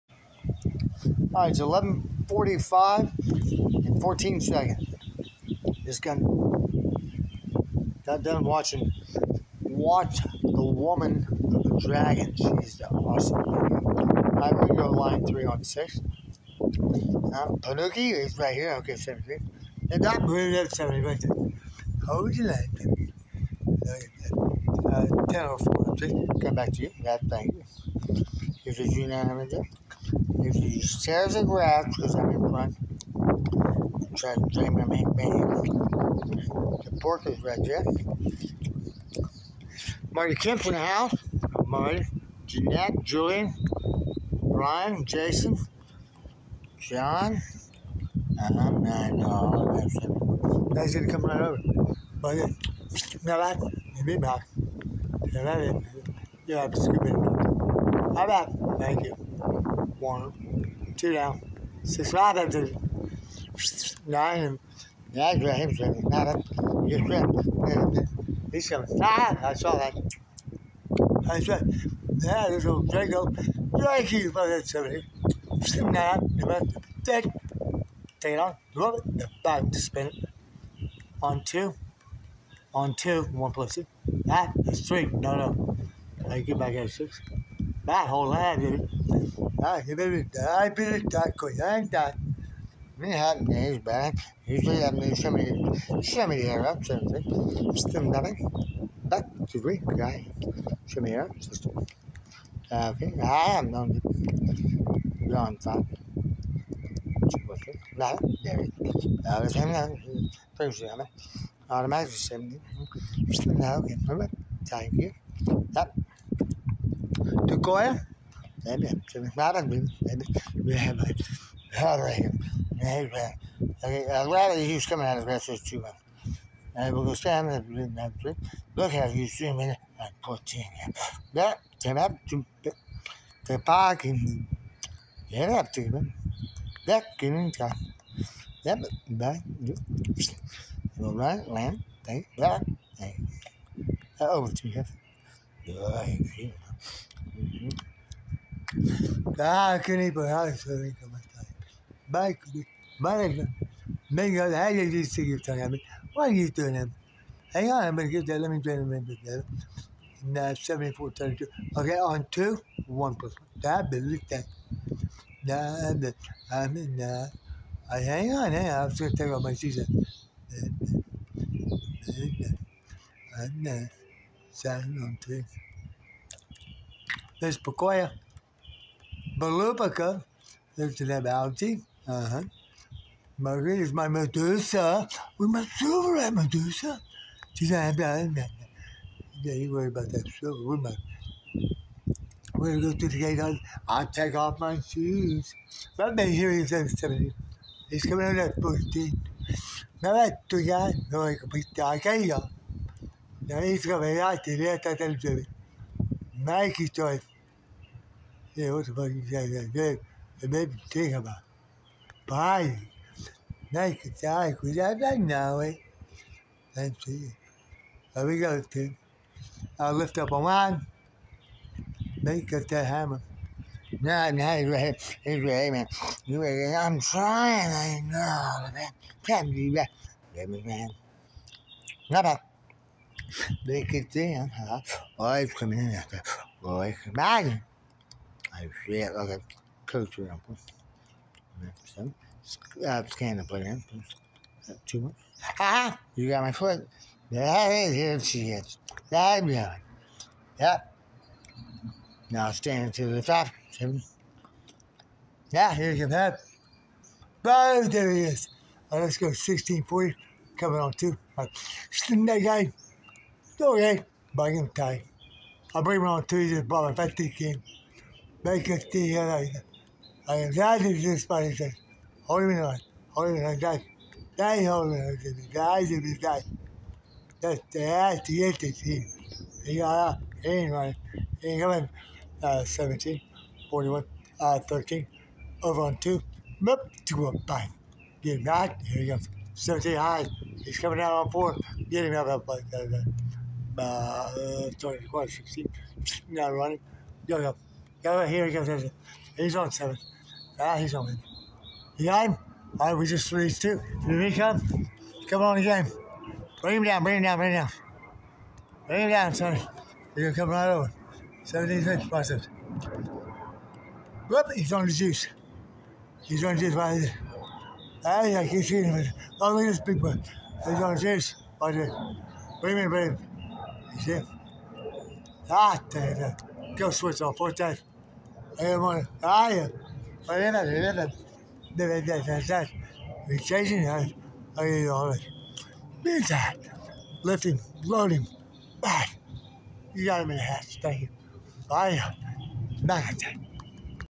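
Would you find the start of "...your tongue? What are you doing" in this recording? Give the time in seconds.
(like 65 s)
155 s.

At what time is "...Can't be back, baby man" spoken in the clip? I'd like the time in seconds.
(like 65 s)
229 s.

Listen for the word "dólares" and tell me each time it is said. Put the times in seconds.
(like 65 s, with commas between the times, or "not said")
334 s.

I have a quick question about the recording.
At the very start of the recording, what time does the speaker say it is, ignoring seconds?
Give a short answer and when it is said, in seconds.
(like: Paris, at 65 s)
11:45, at 1 s.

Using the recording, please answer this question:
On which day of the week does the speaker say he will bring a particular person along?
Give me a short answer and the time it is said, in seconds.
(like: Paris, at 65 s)
Tuesday, at 266 s.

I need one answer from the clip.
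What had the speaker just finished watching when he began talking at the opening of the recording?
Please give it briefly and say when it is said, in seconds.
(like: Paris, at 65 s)
Watch the Woman of the Dragon, at 9 s.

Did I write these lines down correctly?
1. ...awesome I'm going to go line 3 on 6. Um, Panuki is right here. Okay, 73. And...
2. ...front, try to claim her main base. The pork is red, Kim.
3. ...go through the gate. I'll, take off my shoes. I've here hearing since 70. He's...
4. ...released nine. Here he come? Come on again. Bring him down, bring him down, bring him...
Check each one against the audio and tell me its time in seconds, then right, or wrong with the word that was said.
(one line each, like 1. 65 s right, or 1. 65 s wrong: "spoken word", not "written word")
1. 12 s right
2. 32 s wrong: "Jeff", not "Kim"
3. 192 s right
4. 303 s wrong: "two", not "nine".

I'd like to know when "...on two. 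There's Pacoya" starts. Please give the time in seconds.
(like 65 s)
175 s.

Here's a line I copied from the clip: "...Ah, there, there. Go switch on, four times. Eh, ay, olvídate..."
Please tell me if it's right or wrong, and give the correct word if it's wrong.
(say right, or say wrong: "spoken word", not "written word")
right.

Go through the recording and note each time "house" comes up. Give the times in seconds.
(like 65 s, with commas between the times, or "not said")
40 s, 340 s.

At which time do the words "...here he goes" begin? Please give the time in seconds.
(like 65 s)
298 s.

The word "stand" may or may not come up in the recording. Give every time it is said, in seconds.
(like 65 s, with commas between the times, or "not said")
127 s, 252 s.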